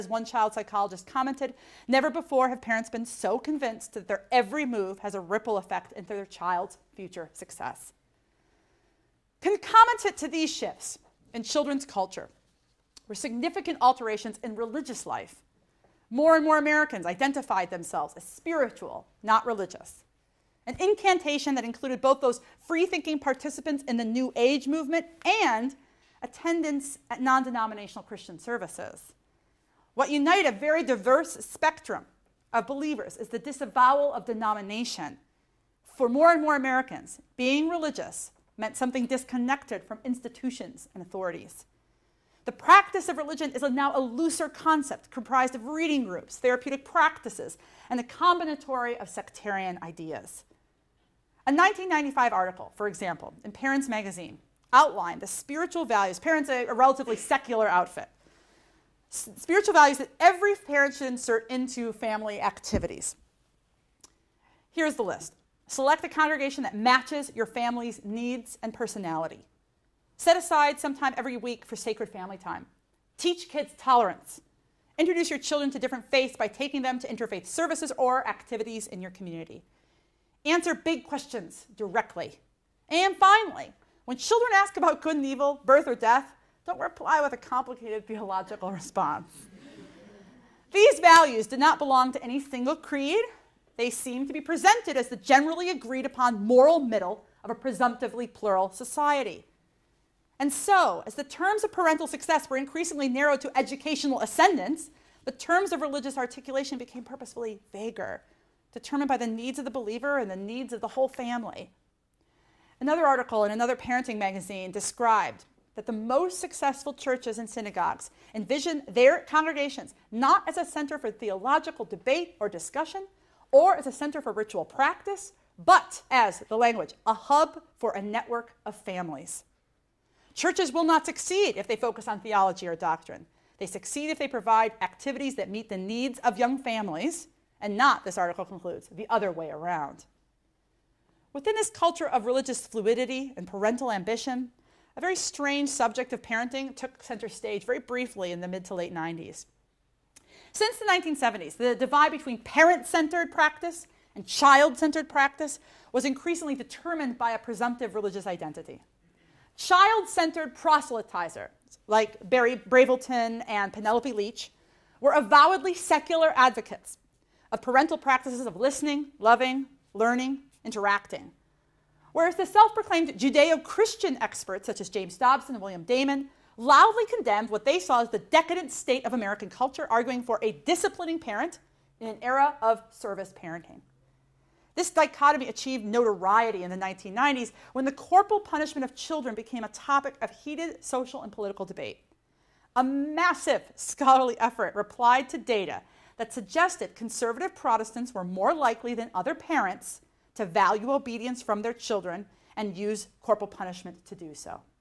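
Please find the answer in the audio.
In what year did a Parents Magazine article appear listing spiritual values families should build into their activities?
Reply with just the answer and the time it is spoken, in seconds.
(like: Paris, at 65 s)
1995, at 51 s.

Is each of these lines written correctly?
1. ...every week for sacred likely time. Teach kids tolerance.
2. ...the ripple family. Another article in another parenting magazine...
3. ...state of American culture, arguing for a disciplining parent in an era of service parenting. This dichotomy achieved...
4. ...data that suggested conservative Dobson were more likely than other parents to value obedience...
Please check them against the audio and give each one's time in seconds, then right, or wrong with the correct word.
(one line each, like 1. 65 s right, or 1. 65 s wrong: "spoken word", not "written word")
1. 71 s wrong: "family", not "likely"
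2. 110 s wrong: "whole", not "ripple"
3. 178 s right
4. 195 s wrong: "Protestants", not "Dobson".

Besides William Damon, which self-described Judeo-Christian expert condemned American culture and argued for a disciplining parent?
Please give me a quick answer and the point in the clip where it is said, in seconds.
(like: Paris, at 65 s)
James Dobson, at 174 s.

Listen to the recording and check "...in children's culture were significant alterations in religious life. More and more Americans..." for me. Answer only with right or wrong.
right.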